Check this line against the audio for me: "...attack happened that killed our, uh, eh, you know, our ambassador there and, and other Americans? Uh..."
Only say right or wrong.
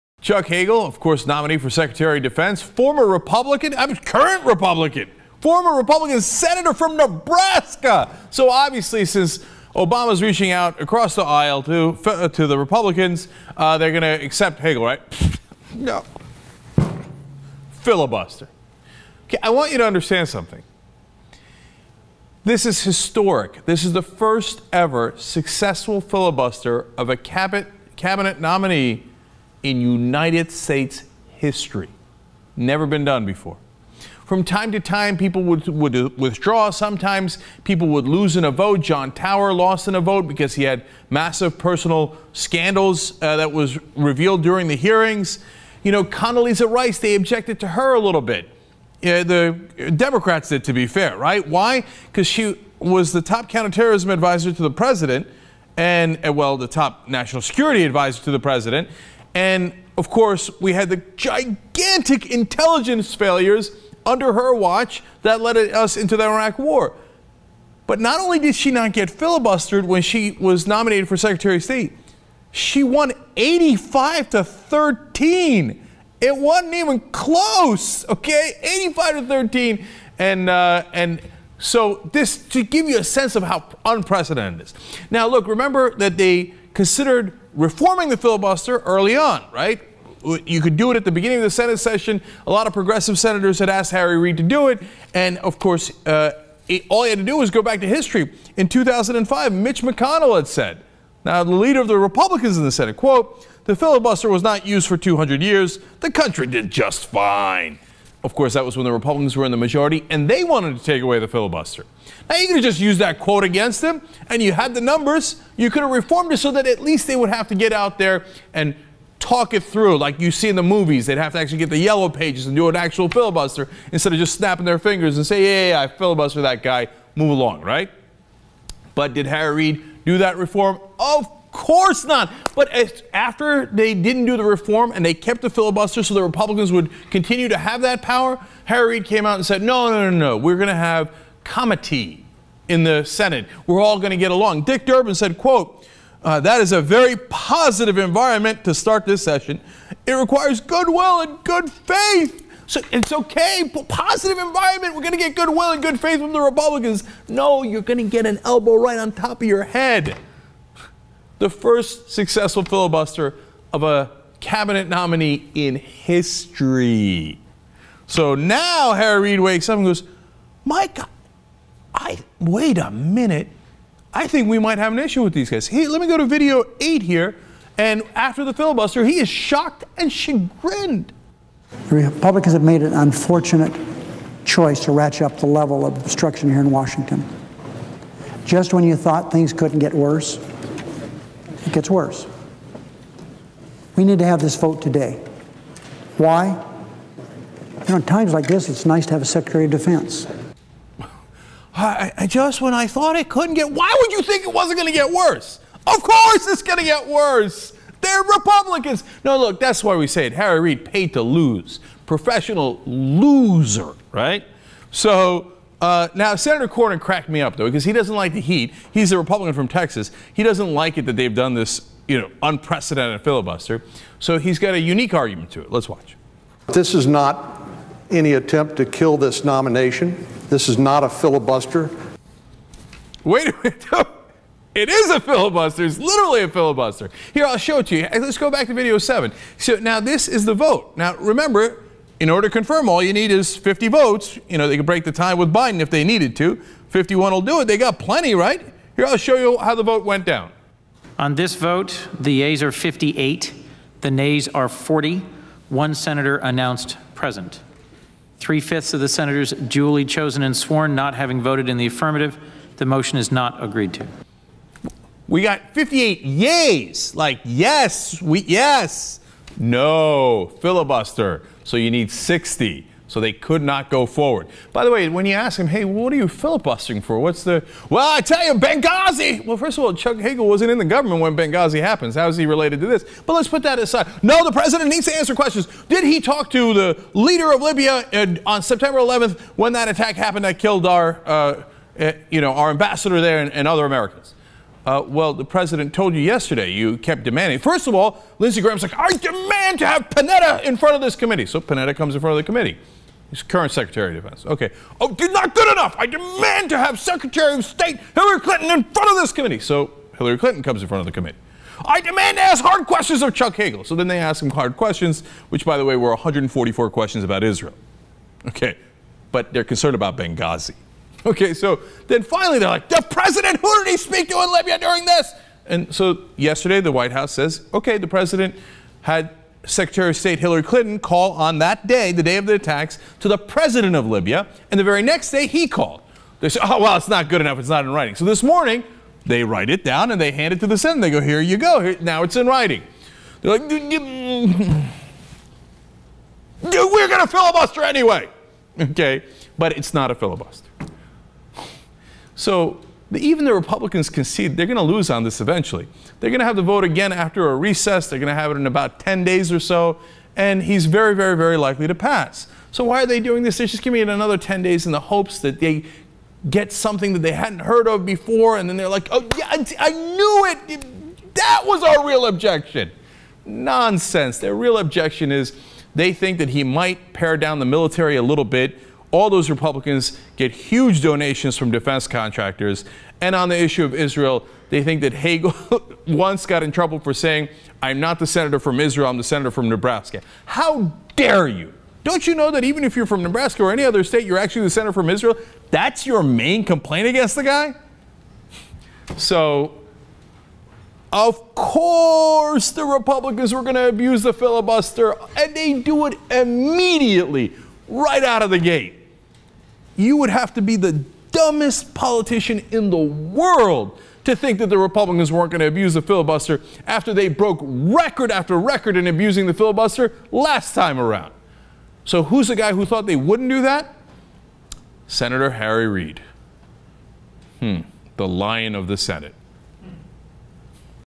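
right.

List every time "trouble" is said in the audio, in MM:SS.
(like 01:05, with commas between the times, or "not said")
06:26.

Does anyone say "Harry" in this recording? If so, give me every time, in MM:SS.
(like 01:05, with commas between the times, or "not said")
01:33, 02:09, 02:18, 02:48, 03:30, 07:05.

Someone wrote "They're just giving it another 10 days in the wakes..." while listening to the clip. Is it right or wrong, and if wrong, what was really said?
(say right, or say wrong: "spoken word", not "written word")
wrong: "hopes", not "wakes".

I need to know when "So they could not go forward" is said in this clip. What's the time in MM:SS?
04:33.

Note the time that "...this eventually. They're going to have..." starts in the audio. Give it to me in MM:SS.
05:55.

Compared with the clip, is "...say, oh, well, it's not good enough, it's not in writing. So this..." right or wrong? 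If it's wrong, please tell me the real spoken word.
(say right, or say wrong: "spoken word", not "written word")
right.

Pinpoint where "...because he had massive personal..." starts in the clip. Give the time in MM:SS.
00:40.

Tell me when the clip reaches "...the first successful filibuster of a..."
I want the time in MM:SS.
02:41.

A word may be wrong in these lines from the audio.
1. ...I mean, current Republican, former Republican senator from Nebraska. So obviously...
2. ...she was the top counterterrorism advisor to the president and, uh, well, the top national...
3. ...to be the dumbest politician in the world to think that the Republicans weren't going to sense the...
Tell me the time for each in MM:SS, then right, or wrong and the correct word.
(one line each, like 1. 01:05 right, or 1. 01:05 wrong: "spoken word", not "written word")
1. 00:03 right
2. 00:52 right
3. 06:50 wrong: "abuse", not "sense".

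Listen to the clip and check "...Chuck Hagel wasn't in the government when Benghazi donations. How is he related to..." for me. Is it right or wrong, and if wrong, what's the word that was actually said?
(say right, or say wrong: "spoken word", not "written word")
wrong: "happens", not "donations".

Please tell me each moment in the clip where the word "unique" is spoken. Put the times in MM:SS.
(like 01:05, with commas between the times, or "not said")
03:44.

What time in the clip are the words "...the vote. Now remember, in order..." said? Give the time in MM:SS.
04:00.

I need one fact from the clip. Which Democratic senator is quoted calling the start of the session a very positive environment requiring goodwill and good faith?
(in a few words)
Dick Durbin.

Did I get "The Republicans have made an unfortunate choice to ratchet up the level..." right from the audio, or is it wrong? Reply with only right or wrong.
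right.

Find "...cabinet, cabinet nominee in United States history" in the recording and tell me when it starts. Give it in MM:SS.
00:27.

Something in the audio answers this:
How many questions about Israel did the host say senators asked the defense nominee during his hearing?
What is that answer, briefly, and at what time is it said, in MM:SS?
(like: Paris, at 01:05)
144, at 05:16.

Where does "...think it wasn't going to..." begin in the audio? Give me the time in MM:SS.
03:24.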